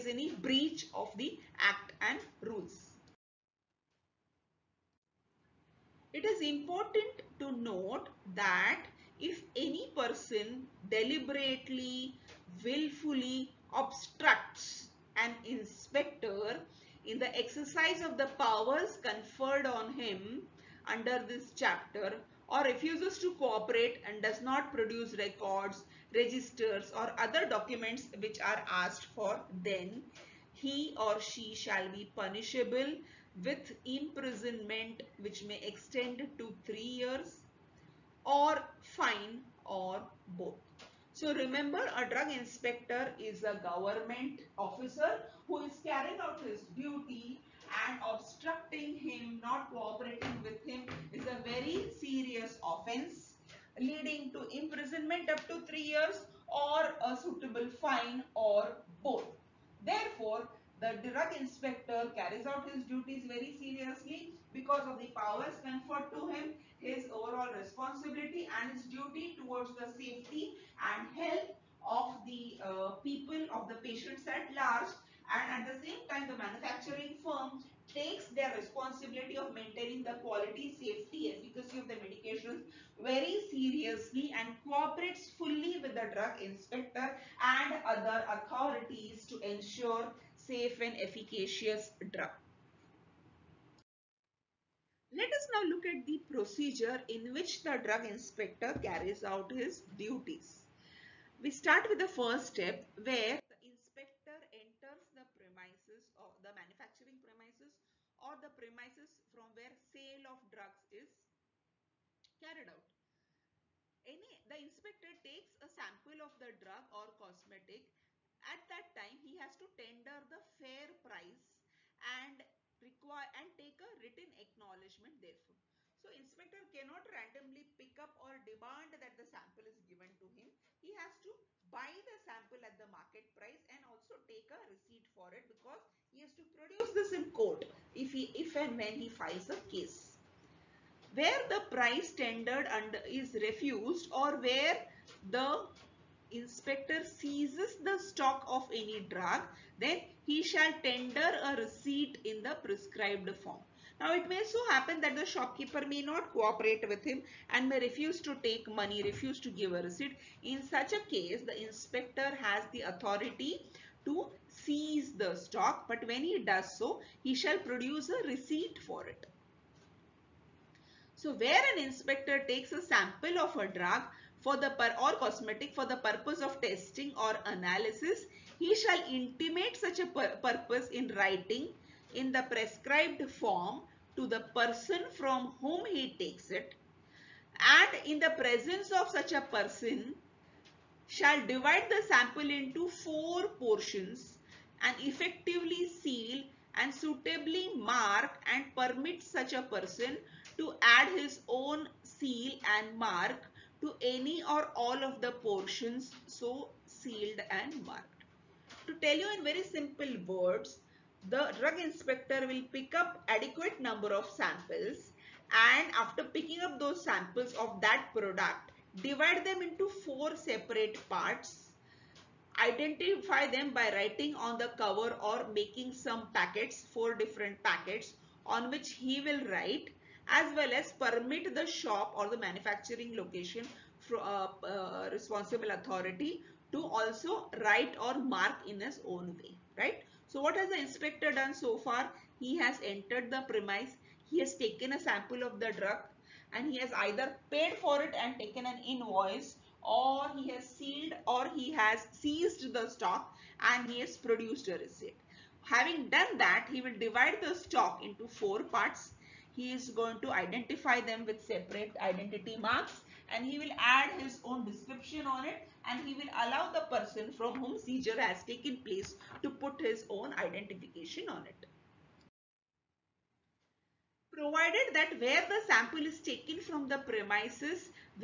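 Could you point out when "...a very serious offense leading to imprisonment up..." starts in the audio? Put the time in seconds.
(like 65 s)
51 s.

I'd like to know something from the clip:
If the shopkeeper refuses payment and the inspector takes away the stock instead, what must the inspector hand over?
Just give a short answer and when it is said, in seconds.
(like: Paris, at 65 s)
a receipt in the prescribed form, at 151 s.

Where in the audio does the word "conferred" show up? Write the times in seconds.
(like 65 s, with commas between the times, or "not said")
19 s, 65 s.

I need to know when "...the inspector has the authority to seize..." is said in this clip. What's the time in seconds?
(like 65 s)
161 s.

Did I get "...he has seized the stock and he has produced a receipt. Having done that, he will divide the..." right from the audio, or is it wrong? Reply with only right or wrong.
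right.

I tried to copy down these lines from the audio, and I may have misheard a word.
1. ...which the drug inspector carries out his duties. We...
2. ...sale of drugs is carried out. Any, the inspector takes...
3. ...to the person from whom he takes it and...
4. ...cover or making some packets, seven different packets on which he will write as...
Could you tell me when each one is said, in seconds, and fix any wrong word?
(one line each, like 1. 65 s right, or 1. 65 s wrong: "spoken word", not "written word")
1. 97 s right
2. 109 s right
3. 184 s right
4. 224 s wrong: "four", not "seven".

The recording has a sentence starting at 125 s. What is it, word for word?
So inspector cannot randomly pick up or demand that the sample is given to him.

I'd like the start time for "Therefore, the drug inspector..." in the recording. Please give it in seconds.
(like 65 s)
59 s.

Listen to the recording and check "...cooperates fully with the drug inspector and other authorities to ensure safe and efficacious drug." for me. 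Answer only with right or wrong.
right.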